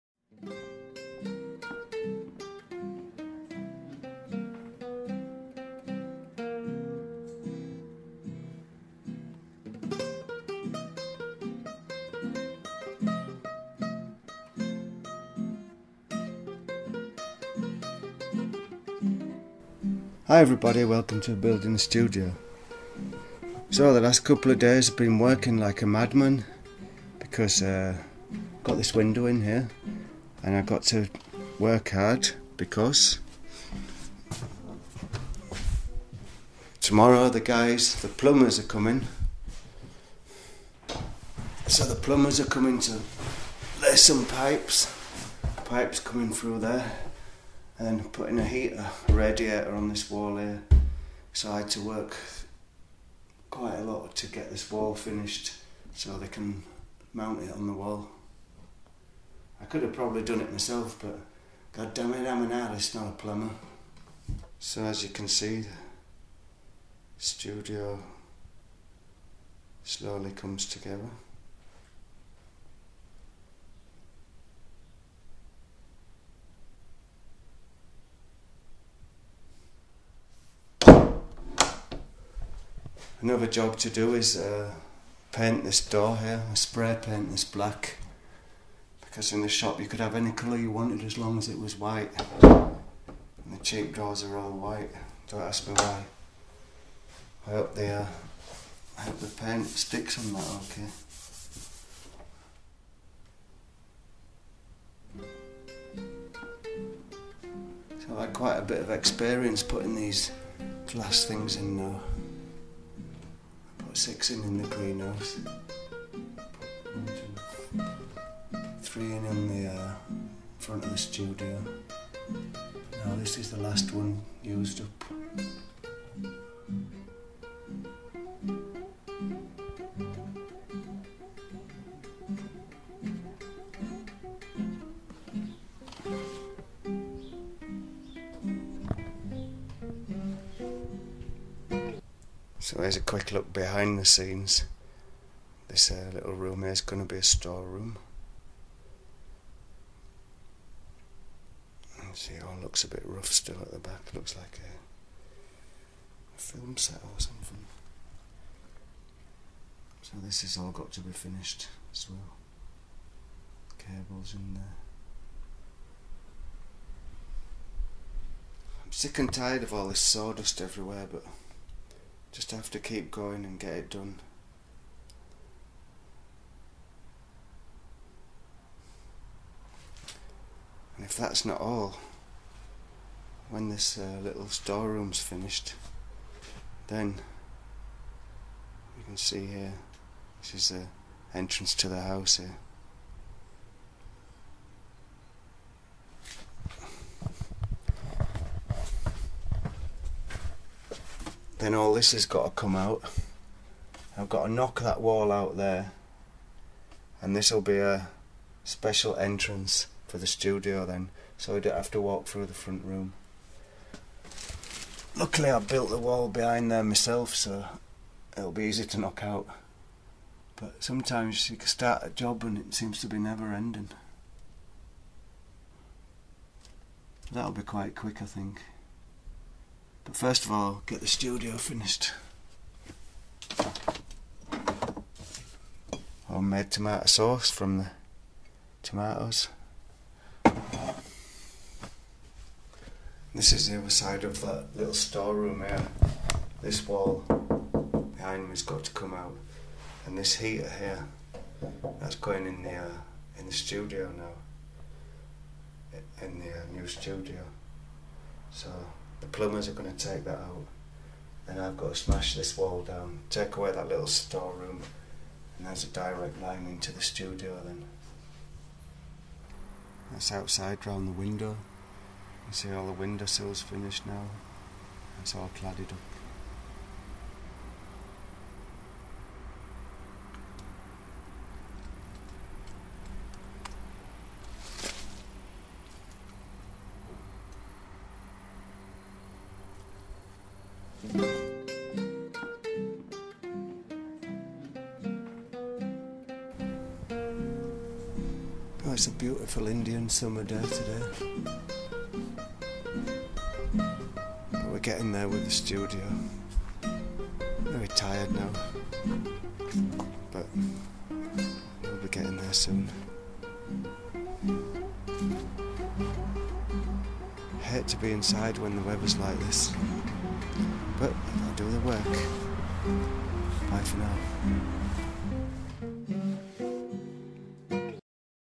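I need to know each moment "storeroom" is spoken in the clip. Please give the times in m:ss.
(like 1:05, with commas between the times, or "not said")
2:27, 3:04, 4:04, 4:24.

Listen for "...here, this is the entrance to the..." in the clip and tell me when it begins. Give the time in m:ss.
3:09.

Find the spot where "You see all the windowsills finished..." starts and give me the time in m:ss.
4:32.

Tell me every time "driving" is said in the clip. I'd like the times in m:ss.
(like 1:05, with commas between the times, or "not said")
not said.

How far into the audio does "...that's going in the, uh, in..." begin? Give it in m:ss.
4:12.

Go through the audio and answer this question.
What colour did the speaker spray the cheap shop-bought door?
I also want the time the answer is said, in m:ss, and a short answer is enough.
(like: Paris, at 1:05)
black, at 1:27.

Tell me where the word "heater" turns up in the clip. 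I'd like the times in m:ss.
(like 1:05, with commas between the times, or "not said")
0:48, 4:10.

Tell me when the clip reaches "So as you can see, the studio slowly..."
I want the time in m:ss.
1:04.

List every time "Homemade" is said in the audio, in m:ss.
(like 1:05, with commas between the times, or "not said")
3:56.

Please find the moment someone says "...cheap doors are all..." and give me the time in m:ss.
1:33.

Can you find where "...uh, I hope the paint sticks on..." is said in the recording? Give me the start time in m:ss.
1:37.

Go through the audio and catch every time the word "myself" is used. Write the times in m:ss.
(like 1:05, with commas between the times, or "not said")
1:00, 3:36.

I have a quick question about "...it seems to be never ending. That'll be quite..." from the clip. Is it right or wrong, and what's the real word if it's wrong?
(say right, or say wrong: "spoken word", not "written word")
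right.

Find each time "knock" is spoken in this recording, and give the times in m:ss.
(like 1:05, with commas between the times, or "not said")
3:24, 3:38.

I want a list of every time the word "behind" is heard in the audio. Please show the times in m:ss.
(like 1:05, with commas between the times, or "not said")
2:23, 3:36, 4:08.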